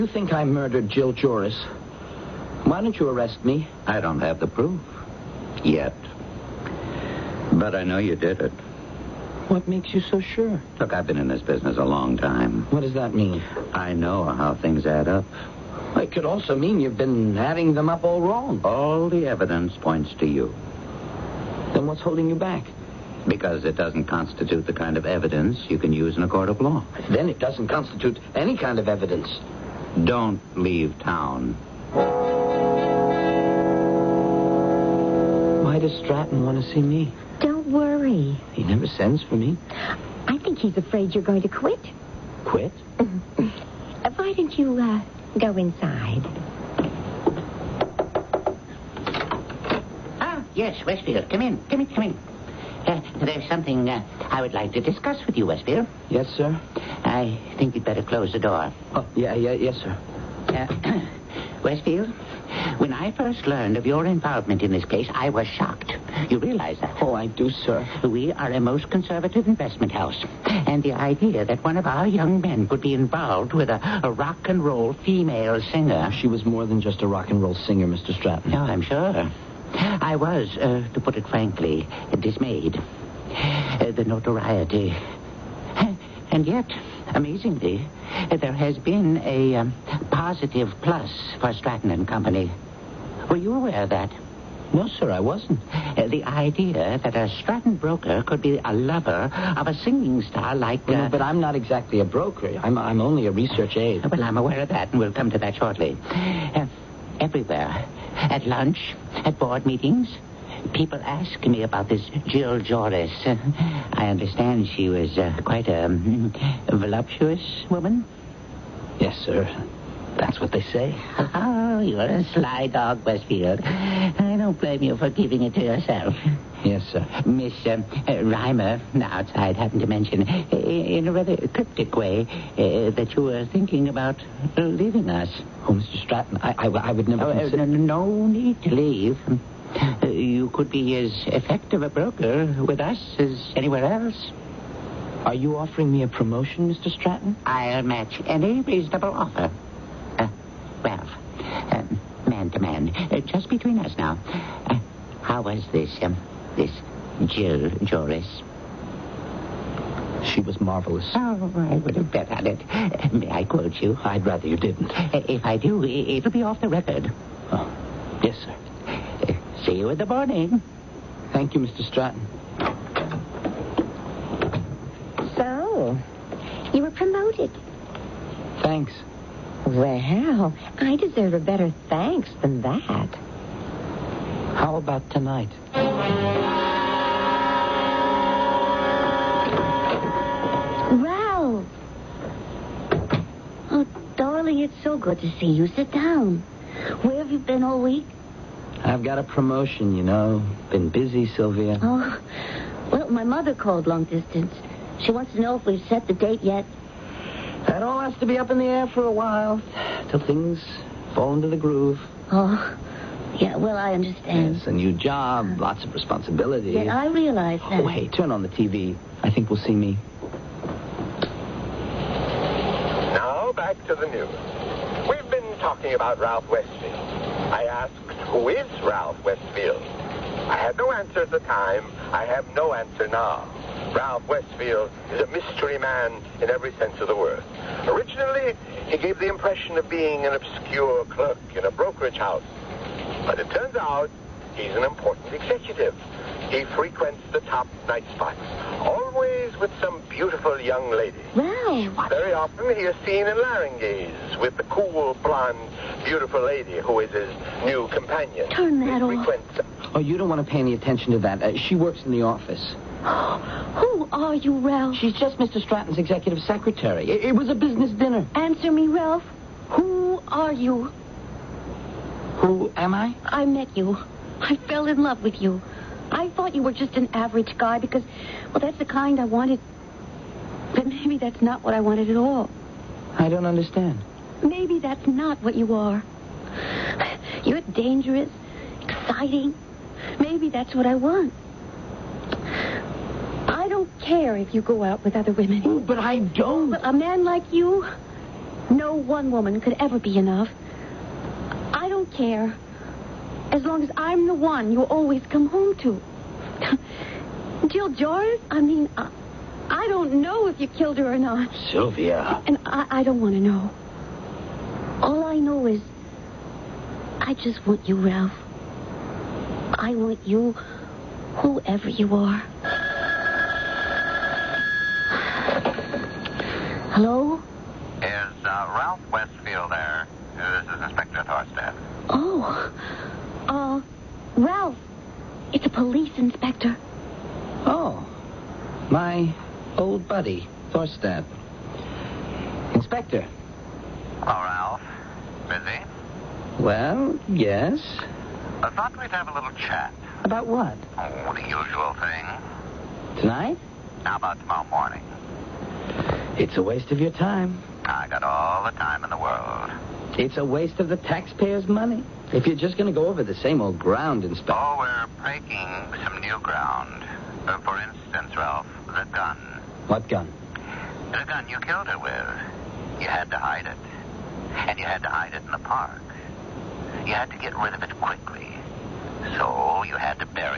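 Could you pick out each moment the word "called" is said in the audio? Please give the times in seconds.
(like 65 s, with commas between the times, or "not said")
203 s.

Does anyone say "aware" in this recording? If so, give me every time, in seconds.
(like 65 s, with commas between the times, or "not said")
93 s, 104 s.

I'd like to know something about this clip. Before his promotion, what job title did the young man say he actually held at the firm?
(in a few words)
research aide.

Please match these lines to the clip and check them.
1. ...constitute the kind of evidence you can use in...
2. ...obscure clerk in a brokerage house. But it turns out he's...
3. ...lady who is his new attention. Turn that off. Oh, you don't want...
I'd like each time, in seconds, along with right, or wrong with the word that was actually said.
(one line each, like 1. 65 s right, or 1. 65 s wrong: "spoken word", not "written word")
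1. 24 s right
2. 240 s right
3. 256 s wrong: "companion", not "attention".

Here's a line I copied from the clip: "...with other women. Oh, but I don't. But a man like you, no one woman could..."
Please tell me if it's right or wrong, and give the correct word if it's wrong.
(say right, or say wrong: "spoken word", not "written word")
right.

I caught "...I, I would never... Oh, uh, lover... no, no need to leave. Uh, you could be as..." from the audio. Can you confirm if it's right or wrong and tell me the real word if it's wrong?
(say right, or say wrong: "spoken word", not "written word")
wrong: "consider", not "lover".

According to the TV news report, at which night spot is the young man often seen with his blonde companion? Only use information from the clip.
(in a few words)
Larynges.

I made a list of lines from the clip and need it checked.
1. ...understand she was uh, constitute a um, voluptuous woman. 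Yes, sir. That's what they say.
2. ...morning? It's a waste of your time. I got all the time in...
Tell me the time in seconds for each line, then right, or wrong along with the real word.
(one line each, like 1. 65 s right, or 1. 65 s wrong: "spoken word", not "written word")
1. 114 s wrong: "quite", not "constitute"
2. 354 s right.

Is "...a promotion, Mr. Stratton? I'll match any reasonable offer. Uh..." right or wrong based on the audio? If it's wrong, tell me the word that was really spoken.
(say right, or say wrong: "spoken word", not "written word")
right.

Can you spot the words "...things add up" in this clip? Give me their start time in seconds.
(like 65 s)
14 s.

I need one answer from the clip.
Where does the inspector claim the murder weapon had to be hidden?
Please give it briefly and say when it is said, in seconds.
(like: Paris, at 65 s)
the park, at 375 s.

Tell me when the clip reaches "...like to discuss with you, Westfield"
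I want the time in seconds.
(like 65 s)
54 s.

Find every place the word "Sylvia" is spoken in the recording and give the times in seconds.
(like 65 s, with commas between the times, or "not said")
201 s, 311 s.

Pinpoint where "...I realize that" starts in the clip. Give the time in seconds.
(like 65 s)
216 s.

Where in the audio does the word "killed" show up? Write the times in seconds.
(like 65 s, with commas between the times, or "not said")
310 s, 371 s.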